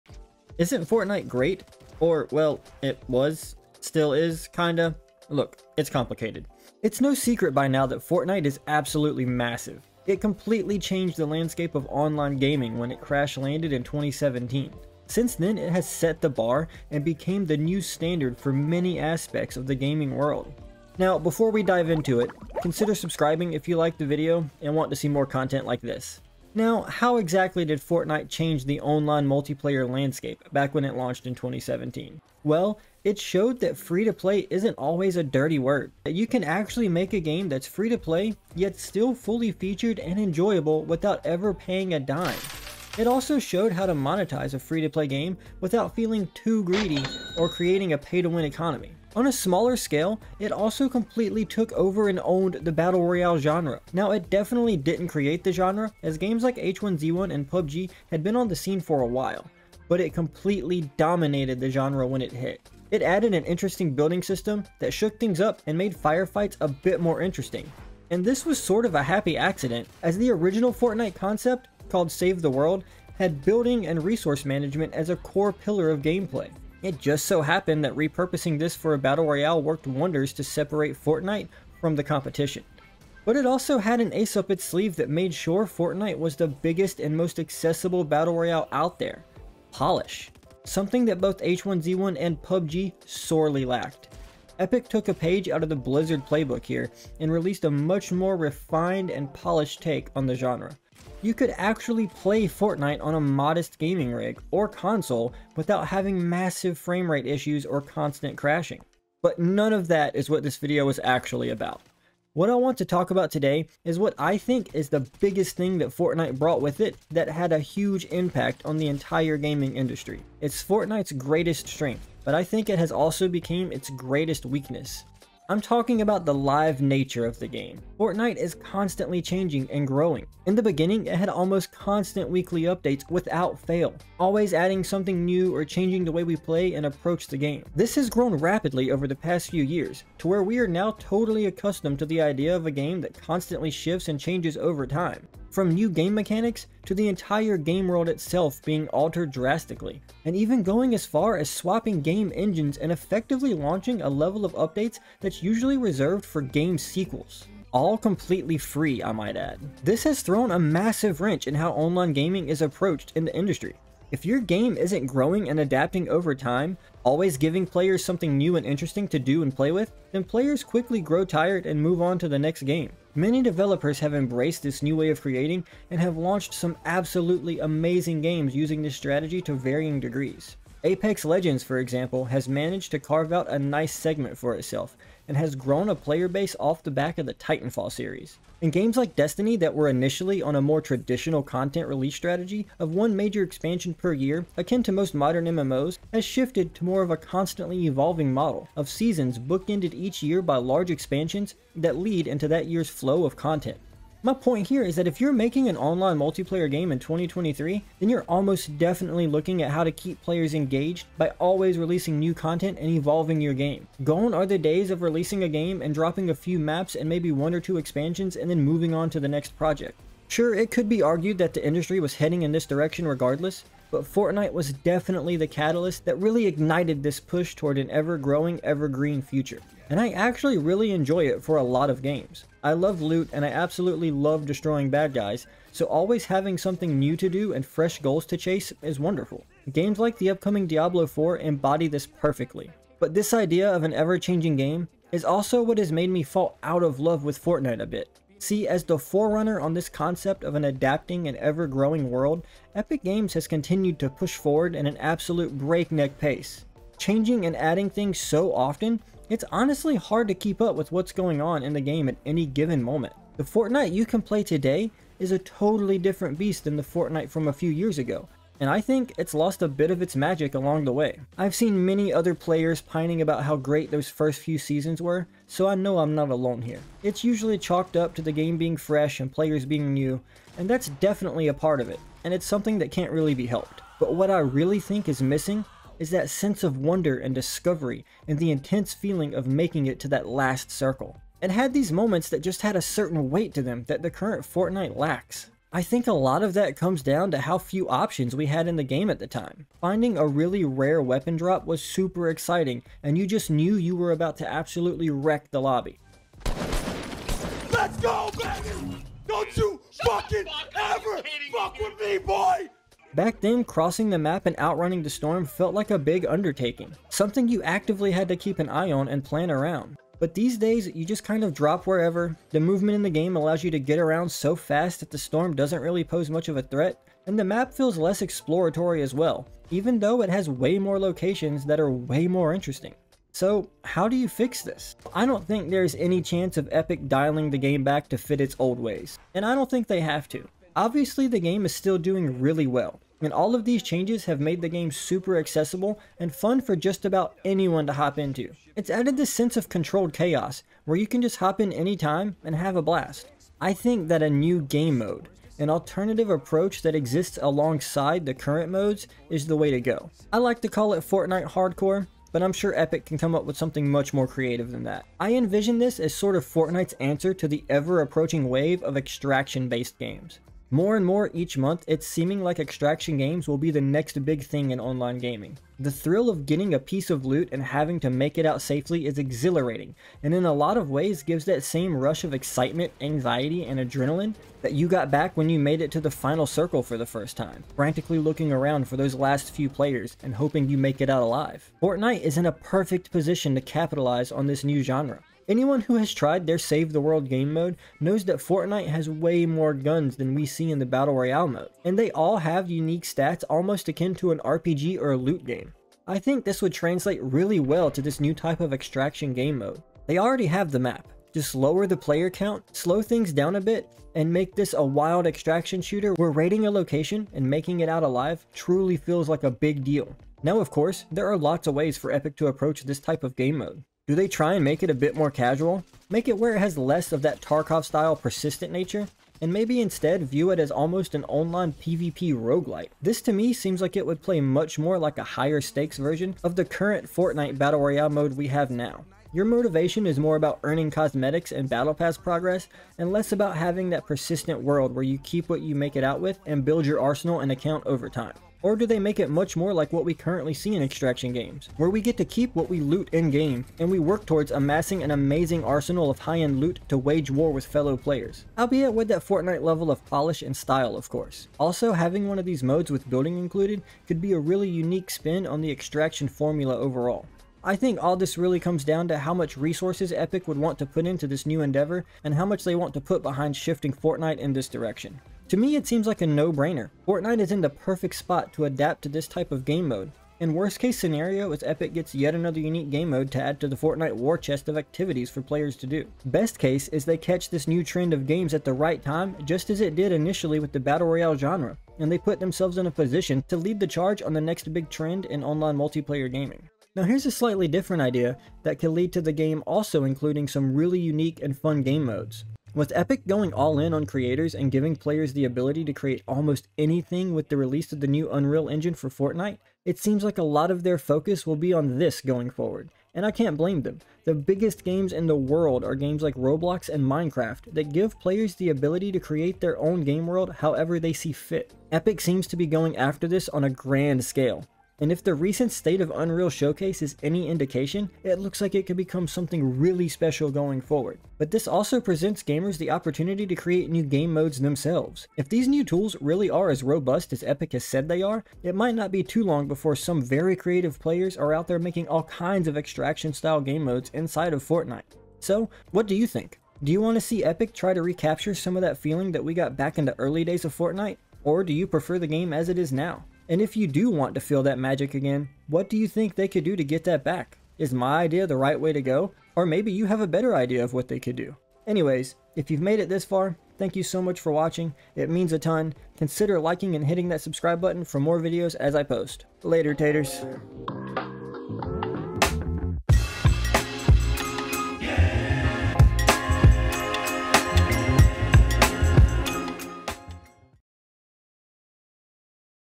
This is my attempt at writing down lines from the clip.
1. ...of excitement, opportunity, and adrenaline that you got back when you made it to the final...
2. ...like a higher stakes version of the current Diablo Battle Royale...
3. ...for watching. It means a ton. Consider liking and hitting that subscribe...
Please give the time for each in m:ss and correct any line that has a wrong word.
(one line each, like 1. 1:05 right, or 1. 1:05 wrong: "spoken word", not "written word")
1. 6:22 wrong: "anxiety", not "opportunity"
2. 7:14 wrong: "Fortnite", not "Diablo"
3. 9:24 right.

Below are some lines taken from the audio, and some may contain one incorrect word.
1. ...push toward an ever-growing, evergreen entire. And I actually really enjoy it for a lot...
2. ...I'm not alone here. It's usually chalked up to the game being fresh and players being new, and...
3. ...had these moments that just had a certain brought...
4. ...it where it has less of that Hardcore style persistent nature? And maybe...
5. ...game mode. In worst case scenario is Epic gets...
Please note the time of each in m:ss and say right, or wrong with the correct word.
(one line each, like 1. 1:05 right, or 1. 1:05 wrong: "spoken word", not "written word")
1. 3:47 wrong: "future", not "entire"
2. 4:35 right
3. 4:51 wrong: "weight", not "brought"
4. 7:06 wrong: "Tarkov", not "Hardcore"
5. 7:59 right.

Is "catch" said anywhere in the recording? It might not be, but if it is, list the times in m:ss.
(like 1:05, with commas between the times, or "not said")
8:07.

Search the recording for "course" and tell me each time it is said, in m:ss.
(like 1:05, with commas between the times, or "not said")
7:00, 7:41.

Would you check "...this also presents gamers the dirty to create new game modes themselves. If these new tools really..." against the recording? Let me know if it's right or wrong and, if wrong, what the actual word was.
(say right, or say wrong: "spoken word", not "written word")
wrong: "opportunity", not "dirty".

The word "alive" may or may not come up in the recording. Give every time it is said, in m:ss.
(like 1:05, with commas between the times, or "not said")
6:31, 6:58.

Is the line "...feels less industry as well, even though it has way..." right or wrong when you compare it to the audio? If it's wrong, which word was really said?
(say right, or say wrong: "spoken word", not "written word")
wrong: "exploratory", not "industry".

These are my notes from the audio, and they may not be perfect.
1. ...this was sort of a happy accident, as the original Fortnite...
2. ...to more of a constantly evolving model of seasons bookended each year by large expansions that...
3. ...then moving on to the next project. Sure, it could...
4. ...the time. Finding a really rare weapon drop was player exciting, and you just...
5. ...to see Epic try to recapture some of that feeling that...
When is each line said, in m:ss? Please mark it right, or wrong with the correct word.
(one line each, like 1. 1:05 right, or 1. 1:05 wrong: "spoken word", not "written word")
1. 1:08 right
2. 3:16 right
3. 3:38 right
4. 4:59 wrong: "super", not "player"
5. 9:07 right.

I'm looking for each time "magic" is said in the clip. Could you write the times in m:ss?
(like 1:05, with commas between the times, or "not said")
4:30, 9:14.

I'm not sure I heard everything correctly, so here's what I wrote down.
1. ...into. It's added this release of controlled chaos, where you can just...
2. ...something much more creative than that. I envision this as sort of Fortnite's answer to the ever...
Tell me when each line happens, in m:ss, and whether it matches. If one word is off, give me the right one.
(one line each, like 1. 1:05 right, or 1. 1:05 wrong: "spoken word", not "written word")
1. 5:48 wrong: "sense", not "release"
2. 6:03 right.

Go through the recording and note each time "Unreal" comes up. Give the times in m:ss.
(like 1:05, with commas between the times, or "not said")
8:28, 8:46.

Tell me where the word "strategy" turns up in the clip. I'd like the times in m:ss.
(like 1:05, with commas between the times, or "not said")
2:58, 3:12.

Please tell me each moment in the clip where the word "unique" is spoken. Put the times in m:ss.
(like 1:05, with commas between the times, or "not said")
6:42, 7:44, 8:02, 8:21.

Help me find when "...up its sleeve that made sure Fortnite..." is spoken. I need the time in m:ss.
1:24.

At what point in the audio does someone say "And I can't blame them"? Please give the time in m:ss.
8:33.